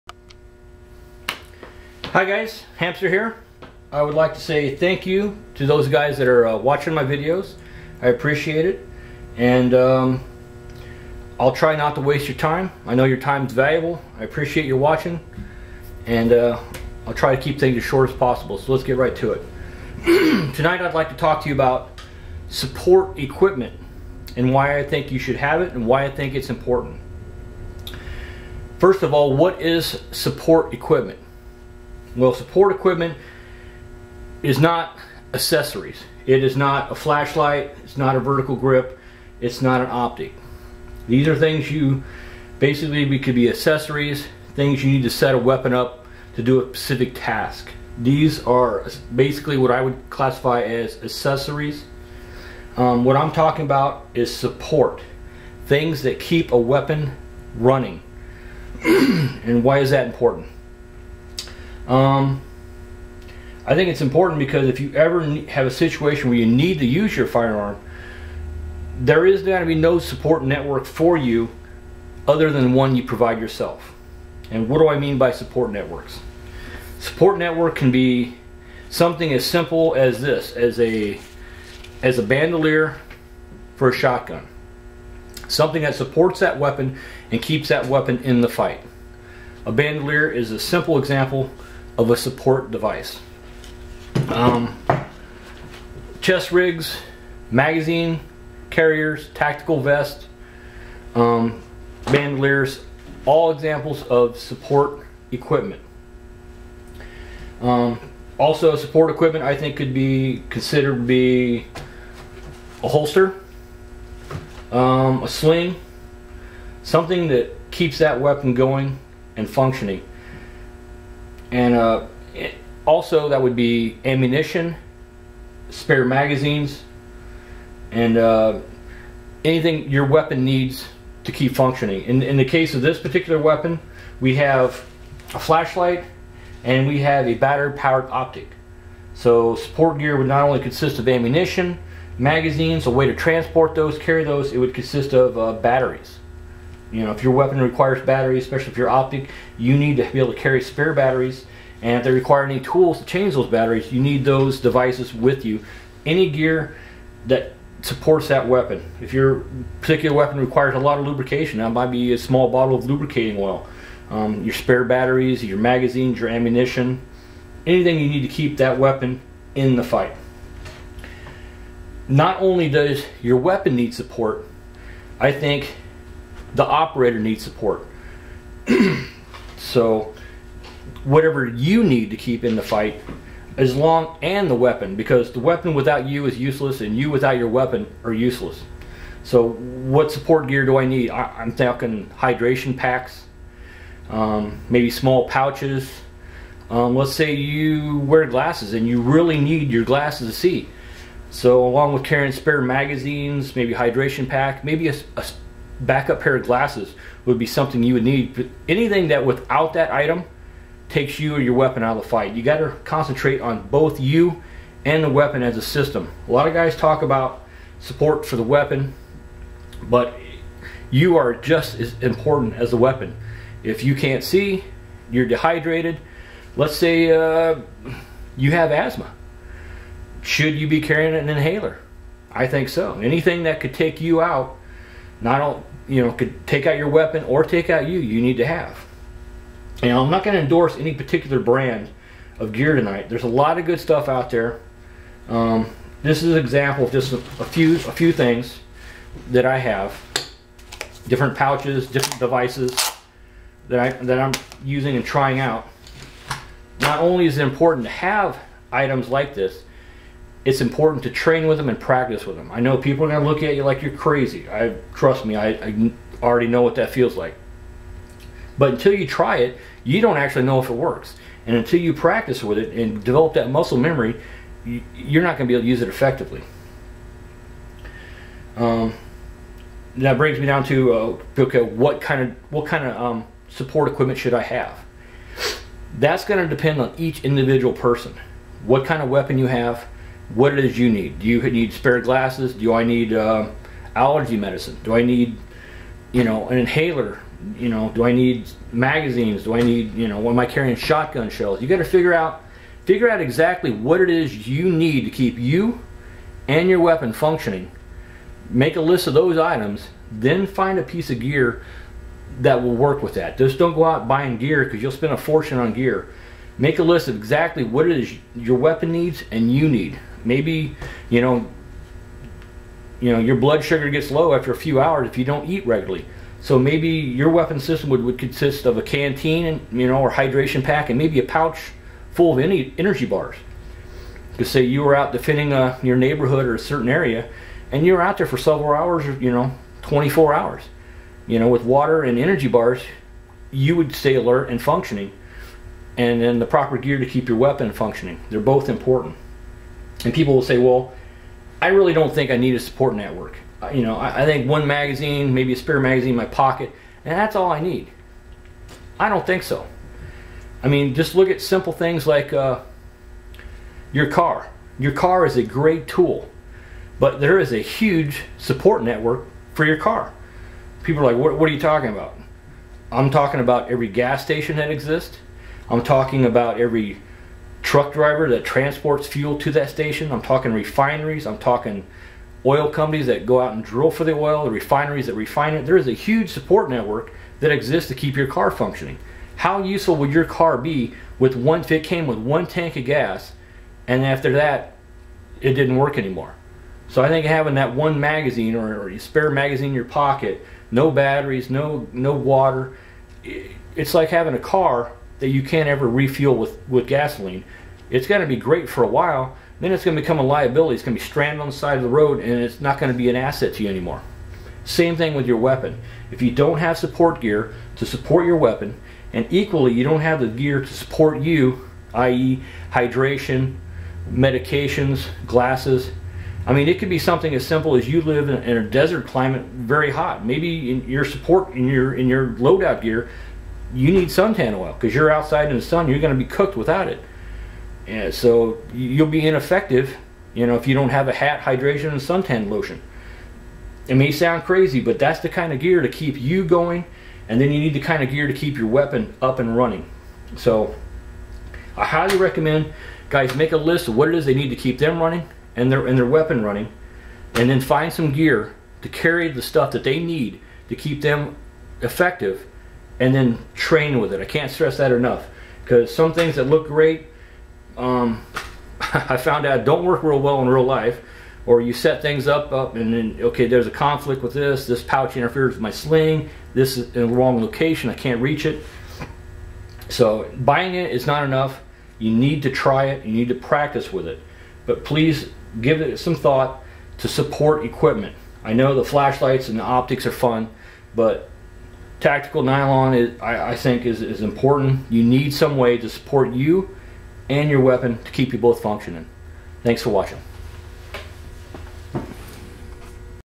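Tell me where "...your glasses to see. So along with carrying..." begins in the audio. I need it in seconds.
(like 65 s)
199 s.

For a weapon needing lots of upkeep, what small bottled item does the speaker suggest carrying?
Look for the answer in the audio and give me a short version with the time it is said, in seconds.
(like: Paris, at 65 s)
Lubricating oil, at 162 s.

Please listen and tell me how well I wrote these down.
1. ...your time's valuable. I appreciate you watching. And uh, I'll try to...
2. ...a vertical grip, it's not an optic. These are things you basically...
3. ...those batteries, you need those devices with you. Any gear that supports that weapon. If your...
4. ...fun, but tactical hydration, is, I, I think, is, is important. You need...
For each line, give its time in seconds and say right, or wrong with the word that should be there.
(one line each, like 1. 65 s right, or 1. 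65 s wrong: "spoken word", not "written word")
1. 13 s right
2. 38 s right
3. 153 s right
4. 490 s wrong: "nylon", not "hydration".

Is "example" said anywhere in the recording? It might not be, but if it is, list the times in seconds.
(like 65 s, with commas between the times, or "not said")
90 s, 103 s, 246 s.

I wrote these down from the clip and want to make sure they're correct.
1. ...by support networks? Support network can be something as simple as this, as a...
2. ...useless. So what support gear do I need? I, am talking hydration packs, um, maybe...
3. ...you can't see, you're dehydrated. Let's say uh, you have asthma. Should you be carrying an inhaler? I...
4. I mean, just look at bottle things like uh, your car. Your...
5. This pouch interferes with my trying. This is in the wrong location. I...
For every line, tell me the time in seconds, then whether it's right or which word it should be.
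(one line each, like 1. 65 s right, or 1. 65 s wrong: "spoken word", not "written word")
1. 75 s right
2. 188 s right
3. 223 s right
4. 360 s wrong: "simple", not "bottle"
5. 474 s wrong: "sling", not "trying".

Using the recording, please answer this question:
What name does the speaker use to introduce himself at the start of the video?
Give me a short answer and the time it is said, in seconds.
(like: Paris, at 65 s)
Hamster, at 2 s.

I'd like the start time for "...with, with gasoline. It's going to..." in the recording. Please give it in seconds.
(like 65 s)
406 s.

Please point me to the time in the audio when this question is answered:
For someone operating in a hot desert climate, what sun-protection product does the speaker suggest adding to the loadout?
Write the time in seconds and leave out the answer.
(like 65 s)
434 s.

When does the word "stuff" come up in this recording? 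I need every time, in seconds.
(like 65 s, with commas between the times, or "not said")
243 s, 459 s.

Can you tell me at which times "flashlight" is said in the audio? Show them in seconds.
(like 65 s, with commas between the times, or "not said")
36 s, 135 s, 488 s.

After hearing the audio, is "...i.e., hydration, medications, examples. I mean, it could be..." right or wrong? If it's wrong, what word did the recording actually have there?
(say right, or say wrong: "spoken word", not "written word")
wrong: "glasses", not "examples".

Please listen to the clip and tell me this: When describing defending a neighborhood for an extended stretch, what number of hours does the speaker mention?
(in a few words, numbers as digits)
24.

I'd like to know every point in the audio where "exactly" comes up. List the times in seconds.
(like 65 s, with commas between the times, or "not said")
303 s, 317 s.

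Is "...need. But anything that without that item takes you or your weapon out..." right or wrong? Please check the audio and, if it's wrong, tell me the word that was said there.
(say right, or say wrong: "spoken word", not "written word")
right.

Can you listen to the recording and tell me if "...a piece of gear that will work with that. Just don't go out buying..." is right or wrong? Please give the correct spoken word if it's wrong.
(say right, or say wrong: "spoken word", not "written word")
right.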